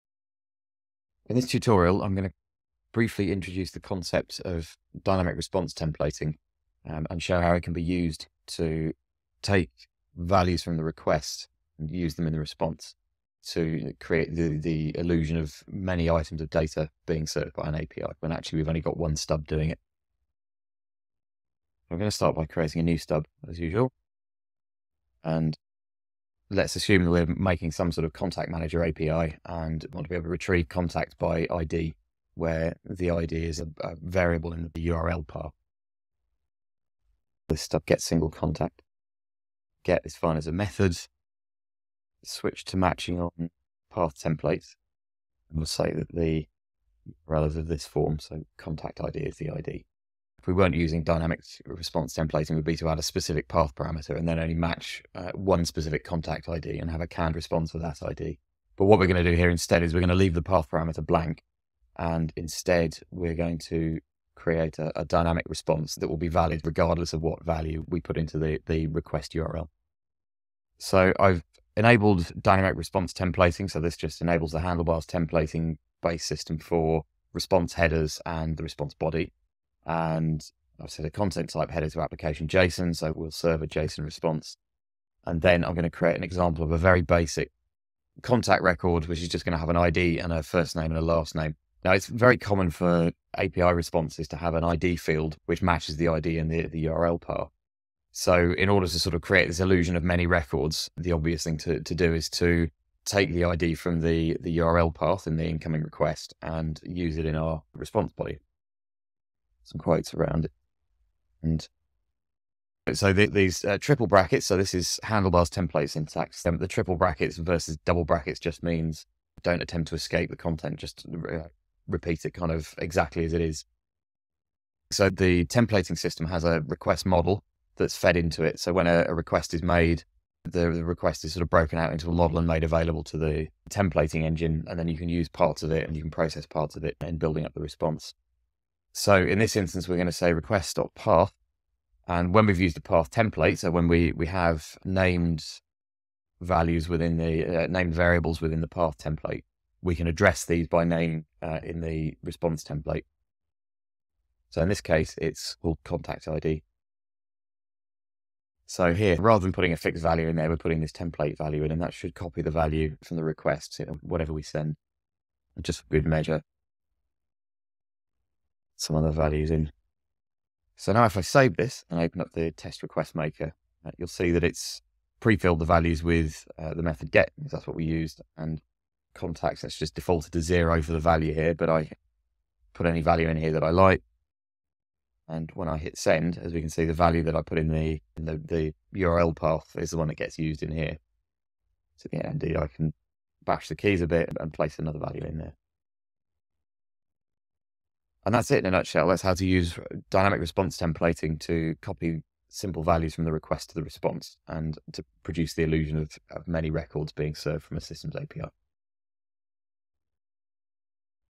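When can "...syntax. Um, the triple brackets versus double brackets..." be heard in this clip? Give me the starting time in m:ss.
1:55.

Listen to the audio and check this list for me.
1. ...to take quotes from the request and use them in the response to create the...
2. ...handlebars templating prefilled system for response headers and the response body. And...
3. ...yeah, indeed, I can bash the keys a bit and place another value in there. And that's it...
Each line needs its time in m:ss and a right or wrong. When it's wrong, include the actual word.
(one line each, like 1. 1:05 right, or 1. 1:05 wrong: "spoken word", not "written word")
1. 0:08 wrong: "values", not "quotes"
2. 1:14 wrong: "based", not "prefilled"
3. 3:12 right.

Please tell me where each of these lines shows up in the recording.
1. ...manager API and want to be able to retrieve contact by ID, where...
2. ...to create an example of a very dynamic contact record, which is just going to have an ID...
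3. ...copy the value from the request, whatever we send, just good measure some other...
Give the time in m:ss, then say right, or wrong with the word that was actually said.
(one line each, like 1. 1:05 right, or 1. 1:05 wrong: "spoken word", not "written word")
1. 0:28 right
2. 1:25 wrong: "basic", not "dynamic"
3. 2:42 right.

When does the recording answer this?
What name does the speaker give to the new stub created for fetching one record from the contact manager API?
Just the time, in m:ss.
0:37.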